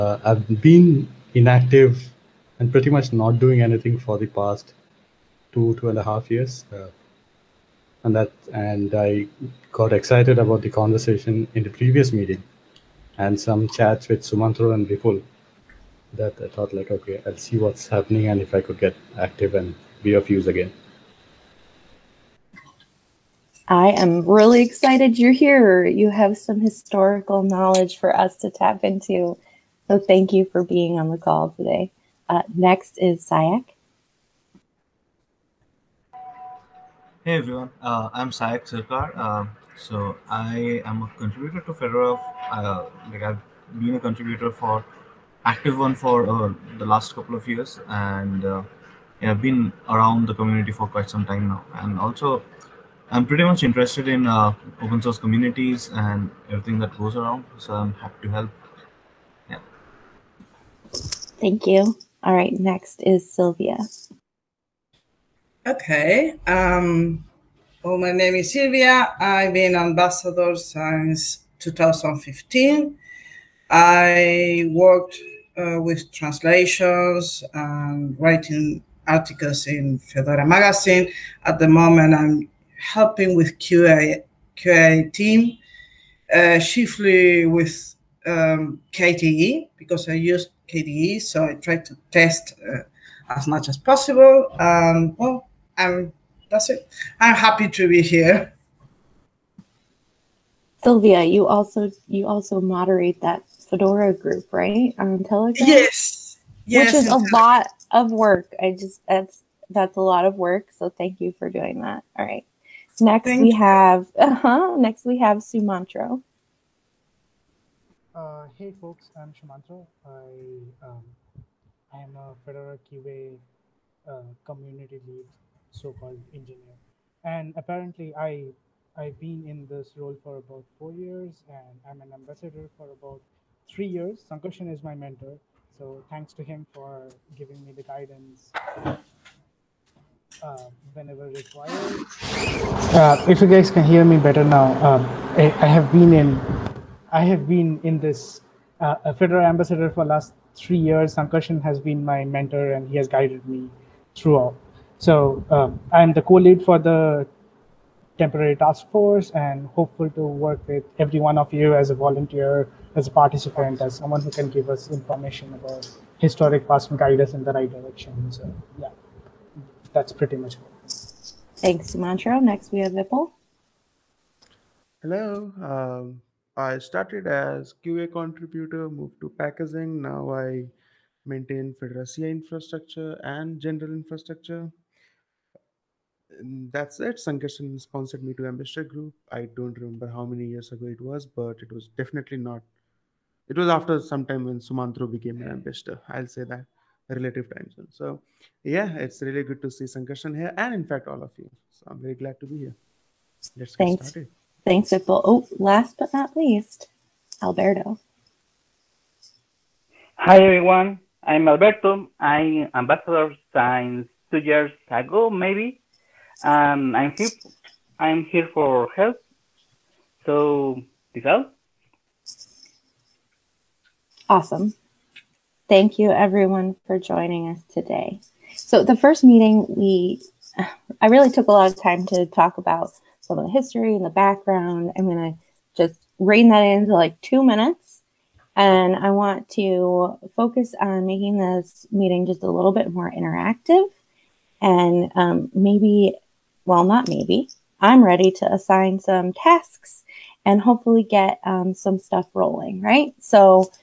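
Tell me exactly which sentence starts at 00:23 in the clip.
I am really excited you're here.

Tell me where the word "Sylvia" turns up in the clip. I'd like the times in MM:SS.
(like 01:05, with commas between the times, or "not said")
01:03, 01:08, 01:40.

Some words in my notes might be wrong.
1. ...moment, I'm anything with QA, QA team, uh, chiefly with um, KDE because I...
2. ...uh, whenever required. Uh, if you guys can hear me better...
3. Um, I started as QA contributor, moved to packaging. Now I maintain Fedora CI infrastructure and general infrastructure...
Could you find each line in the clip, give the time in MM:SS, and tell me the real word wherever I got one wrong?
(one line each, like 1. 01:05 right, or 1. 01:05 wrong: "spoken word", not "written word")
1. 01:21 wrong: "helping", not "anything"
2. 02:20 right
3. 02:55 right.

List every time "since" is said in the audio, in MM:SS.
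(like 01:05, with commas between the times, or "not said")
01:10, 03:33.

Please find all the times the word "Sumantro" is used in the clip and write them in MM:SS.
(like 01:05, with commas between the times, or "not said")
00:14, 01:55, 01:59, 02:51, 03:14.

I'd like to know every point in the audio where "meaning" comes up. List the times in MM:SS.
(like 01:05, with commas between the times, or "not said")
not said.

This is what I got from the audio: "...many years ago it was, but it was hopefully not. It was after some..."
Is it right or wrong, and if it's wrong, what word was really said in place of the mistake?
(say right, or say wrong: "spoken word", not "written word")
wrong: "definitely", not "hopefully".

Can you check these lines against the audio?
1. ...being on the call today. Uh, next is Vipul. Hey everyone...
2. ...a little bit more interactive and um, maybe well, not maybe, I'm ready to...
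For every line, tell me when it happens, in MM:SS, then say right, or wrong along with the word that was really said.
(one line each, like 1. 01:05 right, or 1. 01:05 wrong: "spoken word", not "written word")
1. 00:30 wrong: "Sayak", not "Vipul"
2. 04:02 right.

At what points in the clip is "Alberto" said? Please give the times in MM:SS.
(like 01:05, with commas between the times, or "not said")
03:27, 03:31.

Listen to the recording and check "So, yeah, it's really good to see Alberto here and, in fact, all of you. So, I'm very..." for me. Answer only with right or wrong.
wrong.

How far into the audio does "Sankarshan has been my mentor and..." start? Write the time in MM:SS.
02:31.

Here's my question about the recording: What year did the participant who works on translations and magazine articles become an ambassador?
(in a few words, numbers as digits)
2015.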